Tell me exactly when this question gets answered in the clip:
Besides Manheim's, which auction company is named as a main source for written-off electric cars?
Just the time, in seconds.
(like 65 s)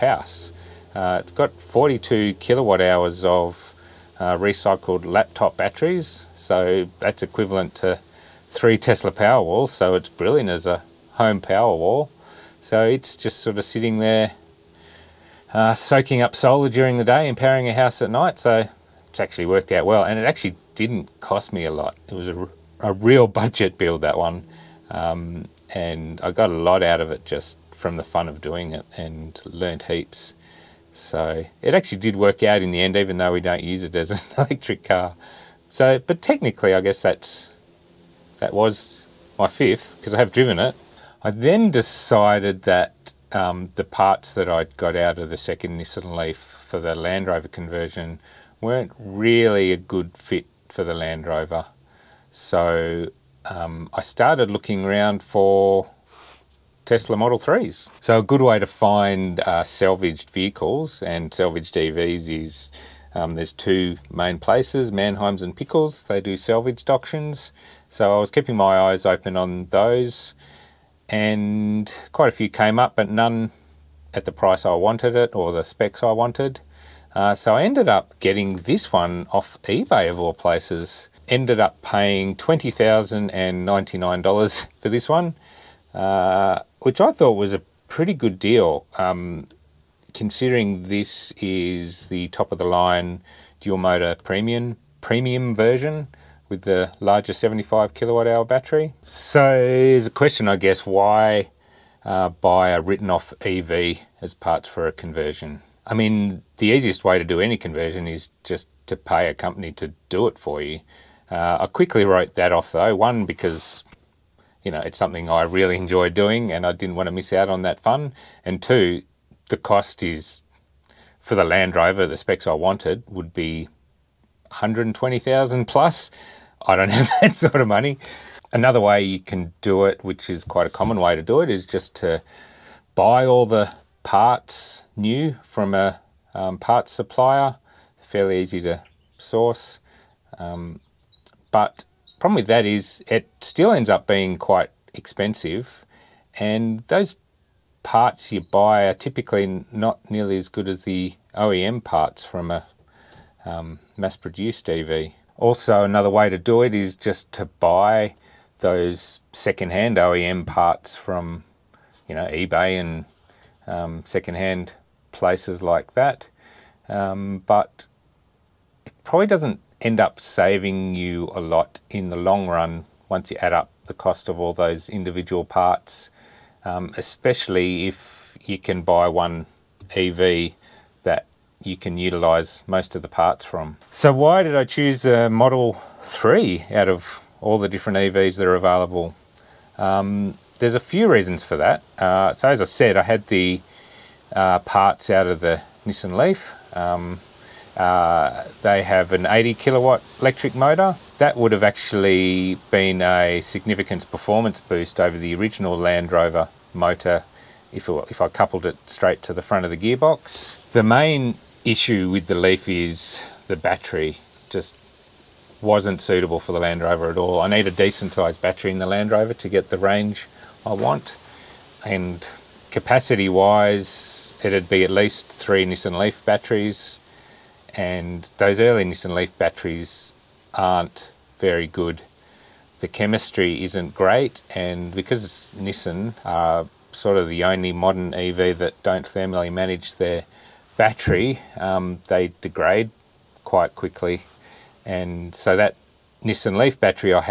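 65 s.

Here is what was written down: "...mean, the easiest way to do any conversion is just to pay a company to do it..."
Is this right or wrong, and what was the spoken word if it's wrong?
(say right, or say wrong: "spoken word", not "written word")
right.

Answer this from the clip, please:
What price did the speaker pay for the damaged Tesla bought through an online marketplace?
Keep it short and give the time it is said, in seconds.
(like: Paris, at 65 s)
$20,099, at 82 s.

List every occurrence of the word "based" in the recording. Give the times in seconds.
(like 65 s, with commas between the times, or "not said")
not said.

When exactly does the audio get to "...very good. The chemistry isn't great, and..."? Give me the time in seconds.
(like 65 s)
231 s.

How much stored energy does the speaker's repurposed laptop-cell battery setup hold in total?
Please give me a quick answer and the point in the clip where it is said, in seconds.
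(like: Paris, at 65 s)
42 kWh, at 1 s.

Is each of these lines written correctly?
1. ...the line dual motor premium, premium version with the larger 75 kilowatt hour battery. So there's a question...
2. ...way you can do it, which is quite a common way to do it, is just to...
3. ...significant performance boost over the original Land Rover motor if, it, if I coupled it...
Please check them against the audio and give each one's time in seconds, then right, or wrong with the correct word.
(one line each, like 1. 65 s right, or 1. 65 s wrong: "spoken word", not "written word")
1. 92 s right
2. 128 s right
3. 203 s right.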